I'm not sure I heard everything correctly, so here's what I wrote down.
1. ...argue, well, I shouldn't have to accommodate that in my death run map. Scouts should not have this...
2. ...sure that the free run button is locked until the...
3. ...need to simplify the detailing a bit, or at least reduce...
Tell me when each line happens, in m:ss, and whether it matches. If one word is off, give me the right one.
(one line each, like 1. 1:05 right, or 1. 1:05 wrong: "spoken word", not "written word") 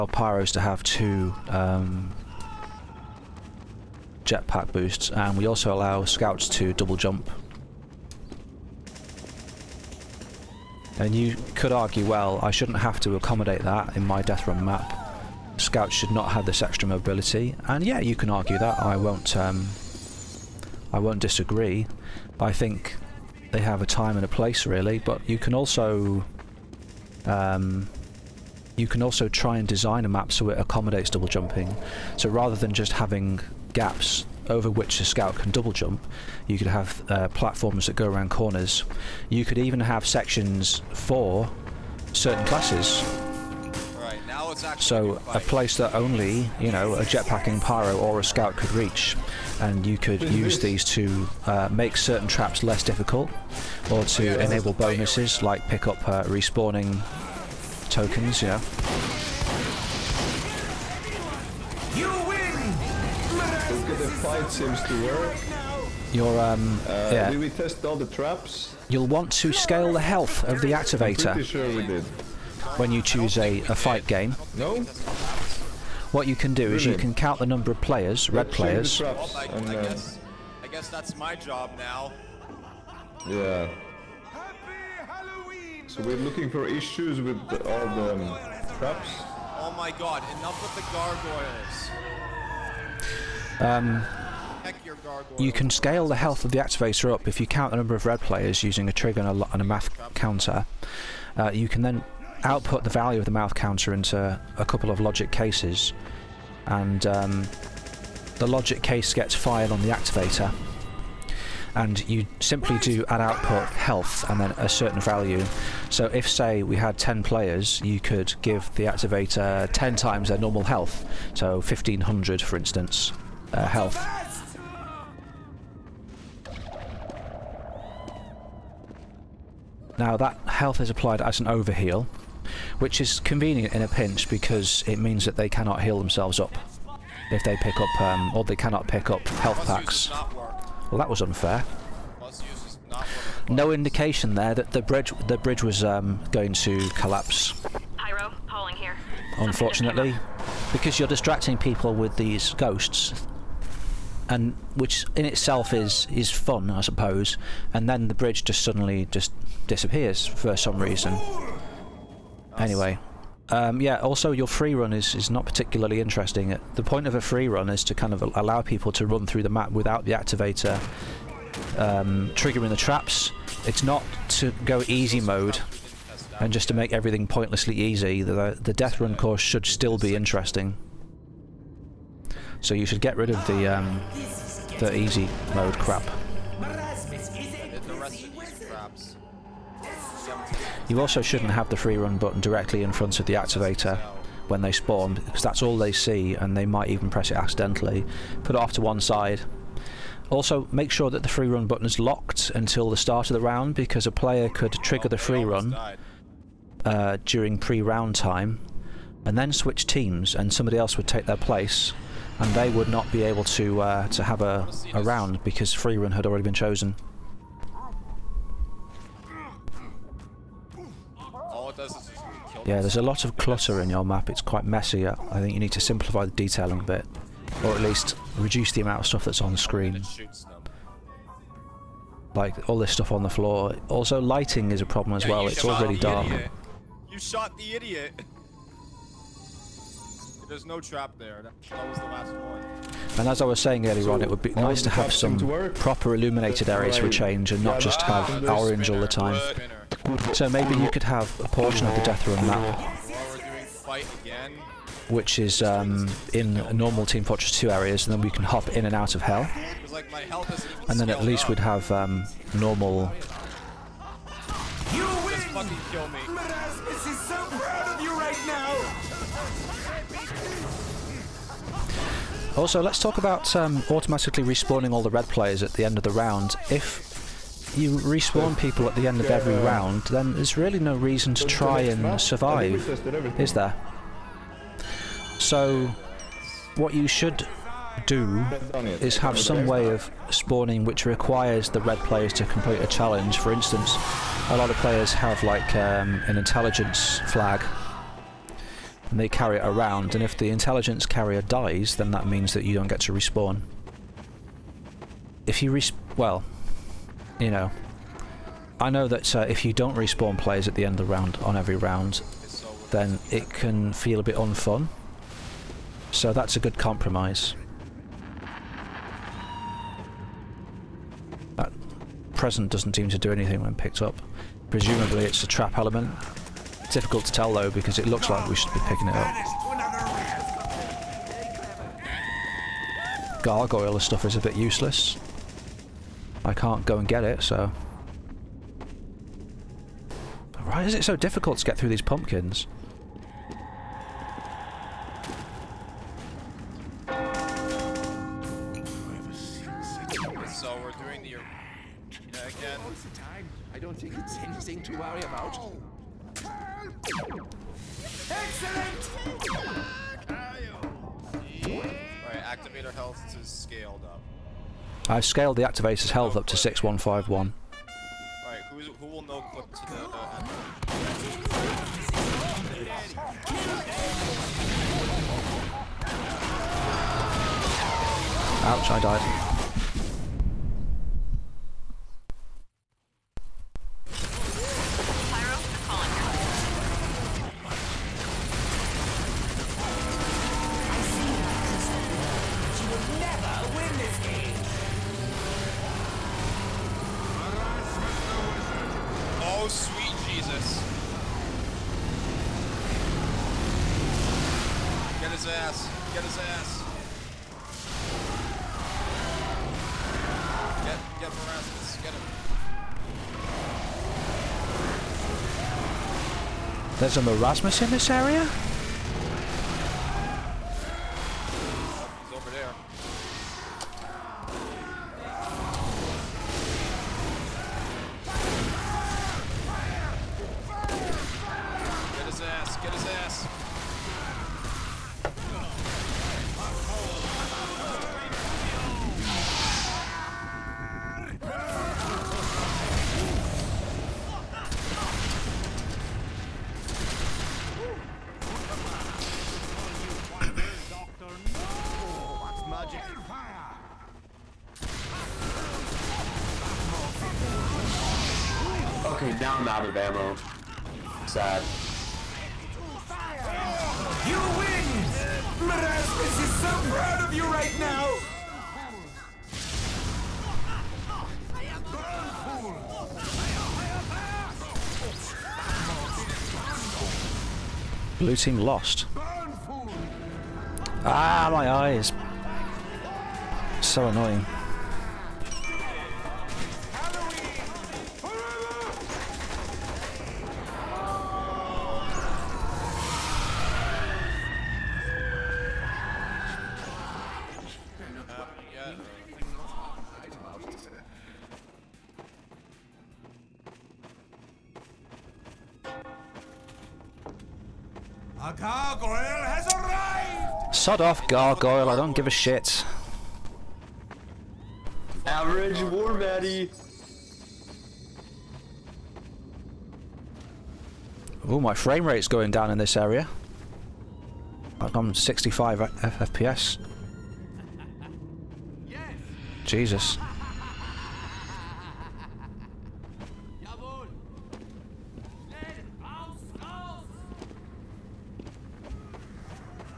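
1. 0:11 right
2. 3:20 right
3. 3:45 right.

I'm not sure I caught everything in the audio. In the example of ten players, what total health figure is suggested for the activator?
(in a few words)
1500.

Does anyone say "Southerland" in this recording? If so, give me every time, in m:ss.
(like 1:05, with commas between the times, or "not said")
not said.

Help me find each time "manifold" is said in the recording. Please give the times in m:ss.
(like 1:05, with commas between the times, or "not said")
not said.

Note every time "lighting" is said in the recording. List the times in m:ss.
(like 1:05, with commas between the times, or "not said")
3:54.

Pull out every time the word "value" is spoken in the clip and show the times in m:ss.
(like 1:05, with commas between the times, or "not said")
1:42, 1:55.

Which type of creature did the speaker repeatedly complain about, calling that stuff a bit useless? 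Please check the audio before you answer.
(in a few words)
gargoyles.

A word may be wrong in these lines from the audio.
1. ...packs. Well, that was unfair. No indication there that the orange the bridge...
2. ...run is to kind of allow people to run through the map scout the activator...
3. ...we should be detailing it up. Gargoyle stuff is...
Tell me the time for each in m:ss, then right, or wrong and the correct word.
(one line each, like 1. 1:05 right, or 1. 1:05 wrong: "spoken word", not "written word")
1. 2:19 wrong: "bridge", not "orange"
2. 2:47 wrong: "without", not "scout"
3. 5:28 wrong: "picking", not "detailing".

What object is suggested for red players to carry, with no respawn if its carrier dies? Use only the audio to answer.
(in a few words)
intelligence flag.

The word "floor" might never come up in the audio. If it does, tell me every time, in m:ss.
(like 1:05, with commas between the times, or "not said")
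3:53.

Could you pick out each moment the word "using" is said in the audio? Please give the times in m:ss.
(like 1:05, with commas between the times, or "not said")
1:38.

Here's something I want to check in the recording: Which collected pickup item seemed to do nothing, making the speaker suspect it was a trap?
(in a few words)
present.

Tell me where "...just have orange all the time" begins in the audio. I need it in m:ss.
4:07.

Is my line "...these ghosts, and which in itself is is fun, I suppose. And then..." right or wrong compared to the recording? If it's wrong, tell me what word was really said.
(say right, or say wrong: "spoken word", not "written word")
right.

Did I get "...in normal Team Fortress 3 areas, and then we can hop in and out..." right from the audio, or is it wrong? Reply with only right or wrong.
wrong.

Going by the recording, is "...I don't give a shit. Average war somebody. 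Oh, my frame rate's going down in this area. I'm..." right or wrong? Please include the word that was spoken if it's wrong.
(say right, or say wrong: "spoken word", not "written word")
wrong: "buddy", not "somebody".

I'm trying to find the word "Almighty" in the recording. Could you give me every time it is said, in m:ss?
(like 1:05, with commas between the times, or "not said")
not said.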